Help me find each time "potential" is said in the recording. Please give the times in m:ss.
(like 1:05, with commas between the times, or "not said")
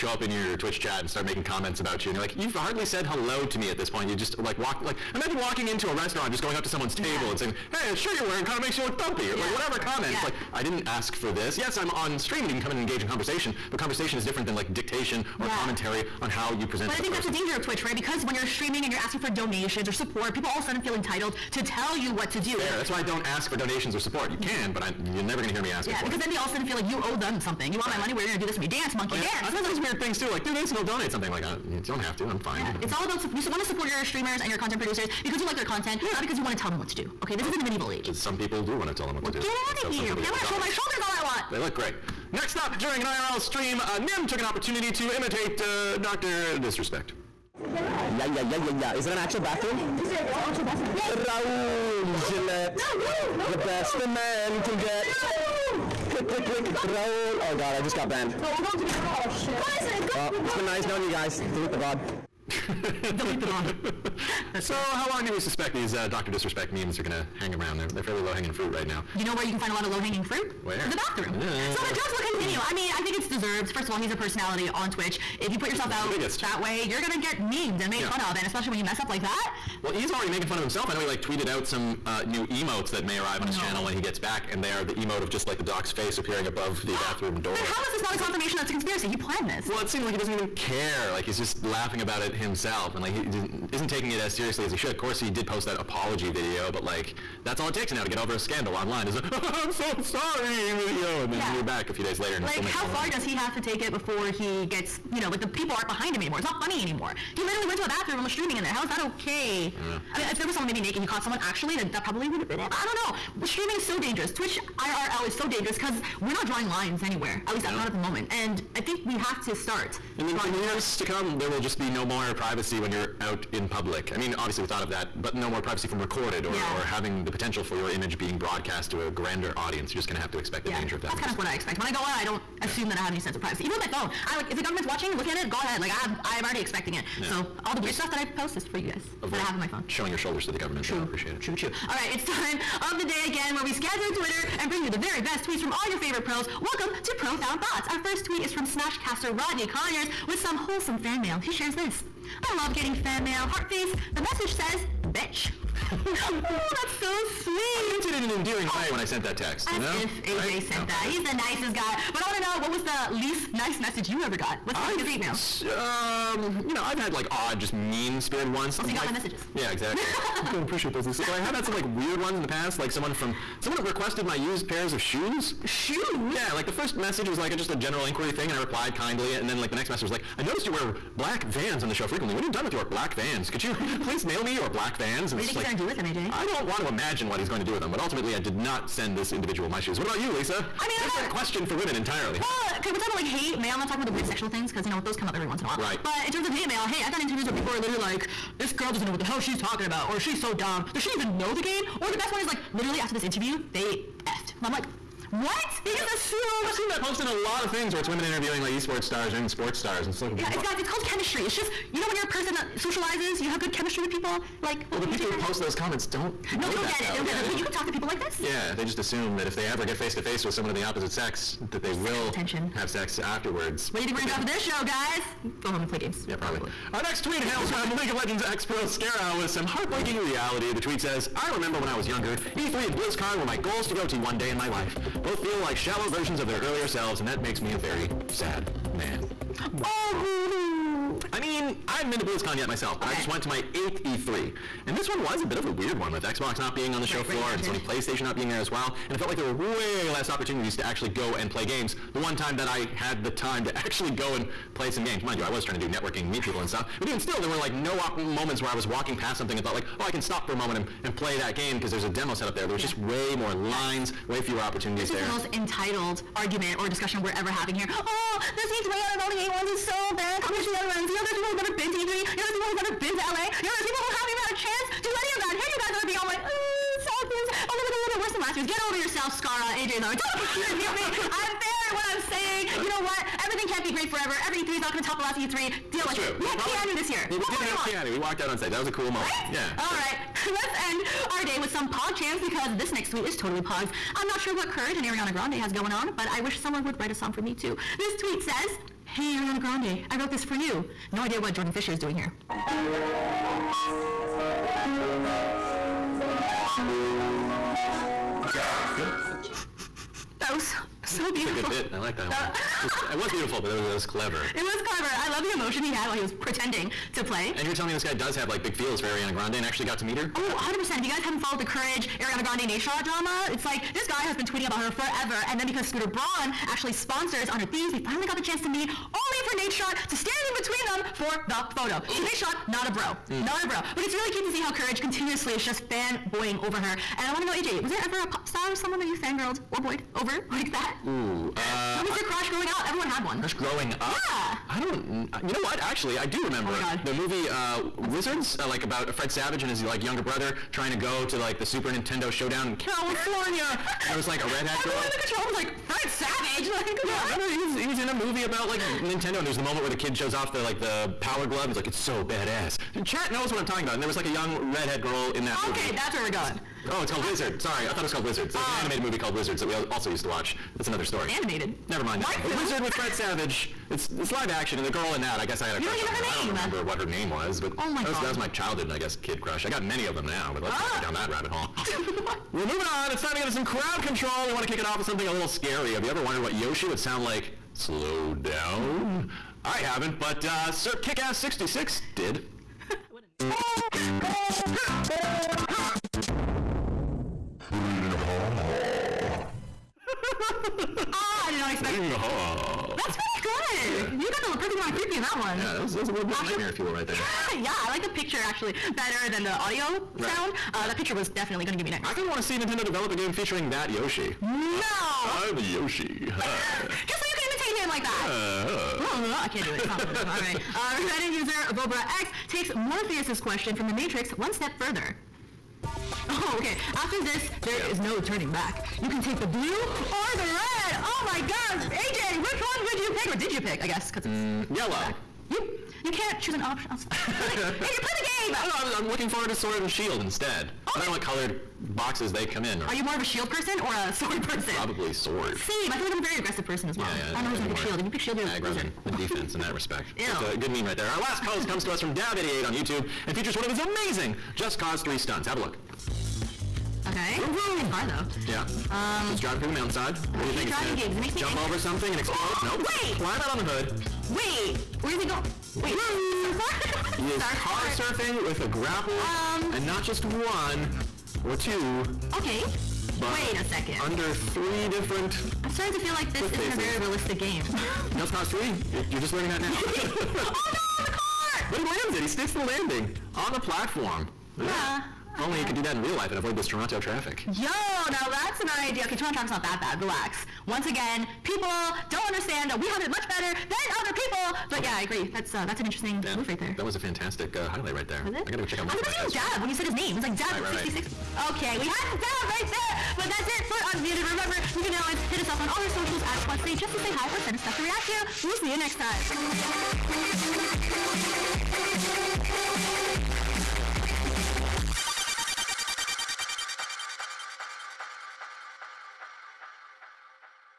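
2:07.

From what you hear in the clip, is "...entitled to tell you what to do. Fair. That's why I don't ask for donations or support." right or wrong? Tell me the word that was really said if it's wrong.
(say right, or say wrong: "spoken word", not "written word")
right.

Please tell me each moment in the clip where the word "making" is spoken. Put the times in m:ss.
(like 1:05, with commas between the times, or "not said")
0:01, 1:20, 1:42.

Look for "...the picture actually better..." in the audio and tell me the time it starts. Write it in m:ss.
6:48.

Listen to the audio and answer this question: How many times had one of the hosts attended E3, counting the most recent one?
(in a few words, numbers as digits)
8.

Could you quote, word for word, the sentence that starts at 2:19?
Showing your shoulders to the government.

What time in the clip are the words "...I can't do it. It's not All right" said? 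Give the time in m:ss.
6:59.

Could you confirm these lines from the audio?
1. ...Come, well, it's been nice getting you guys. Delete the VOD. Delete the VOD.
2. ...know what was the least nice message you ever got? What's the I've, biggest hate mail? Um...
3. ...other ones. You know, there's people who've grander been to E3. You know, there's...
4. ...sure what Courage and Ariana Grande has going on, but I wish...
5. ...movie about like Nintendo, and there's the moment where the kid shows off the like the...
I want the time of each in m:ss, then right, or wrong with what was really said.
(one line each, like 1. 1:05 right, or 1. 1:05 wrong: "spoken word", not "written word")
1. 1:00 wrong: "knowing", not "getting"
2. 2:42 right
3. 4:30 wrong: "never", not "grander"
4. 4:54 right
5. 5:58 right.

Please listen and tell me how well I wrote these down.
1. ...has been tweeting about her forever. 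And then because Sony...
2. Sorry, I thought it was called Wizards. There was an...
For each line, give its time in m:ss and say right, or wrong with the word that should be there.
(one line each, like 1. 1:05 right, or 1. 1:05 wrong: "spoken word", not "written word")
1. 5:24 wrong: "Scooter", not "Sony"
2. 6:07 right.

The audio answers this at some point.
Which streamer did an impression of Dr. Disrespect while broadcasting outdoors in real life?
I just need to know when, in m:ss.
0:43.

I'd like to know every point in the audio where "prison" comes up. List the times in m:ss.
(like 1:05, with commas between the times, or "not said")
not said.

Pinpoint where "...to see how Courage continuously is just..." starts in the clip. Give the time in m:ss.
5:34.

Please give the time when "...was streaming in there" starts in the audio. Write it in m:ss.
1:48.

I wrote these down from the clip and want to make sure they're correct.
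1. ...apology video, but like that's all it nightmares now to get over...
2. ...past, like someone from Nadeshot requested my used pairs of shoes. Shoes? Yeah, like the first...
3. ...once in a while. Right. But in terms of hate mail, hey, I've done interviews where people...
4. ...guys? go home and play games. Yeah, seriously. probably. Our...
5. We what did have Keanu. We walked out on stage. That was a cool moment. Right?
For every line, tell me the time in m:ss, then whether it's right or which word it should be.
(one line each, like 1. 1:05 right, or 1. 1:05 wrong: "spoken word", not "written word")
1. 1:35 wrong: "takes", not "nightmares"
2. 2:52 wrong: "Someone", not "Nadeshot"
3. 3:15 right
4. 3:44 wrong: "probably", not "seriously"
5. 4:47 right.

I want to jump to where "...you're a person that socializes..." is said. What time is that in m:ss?
3:32.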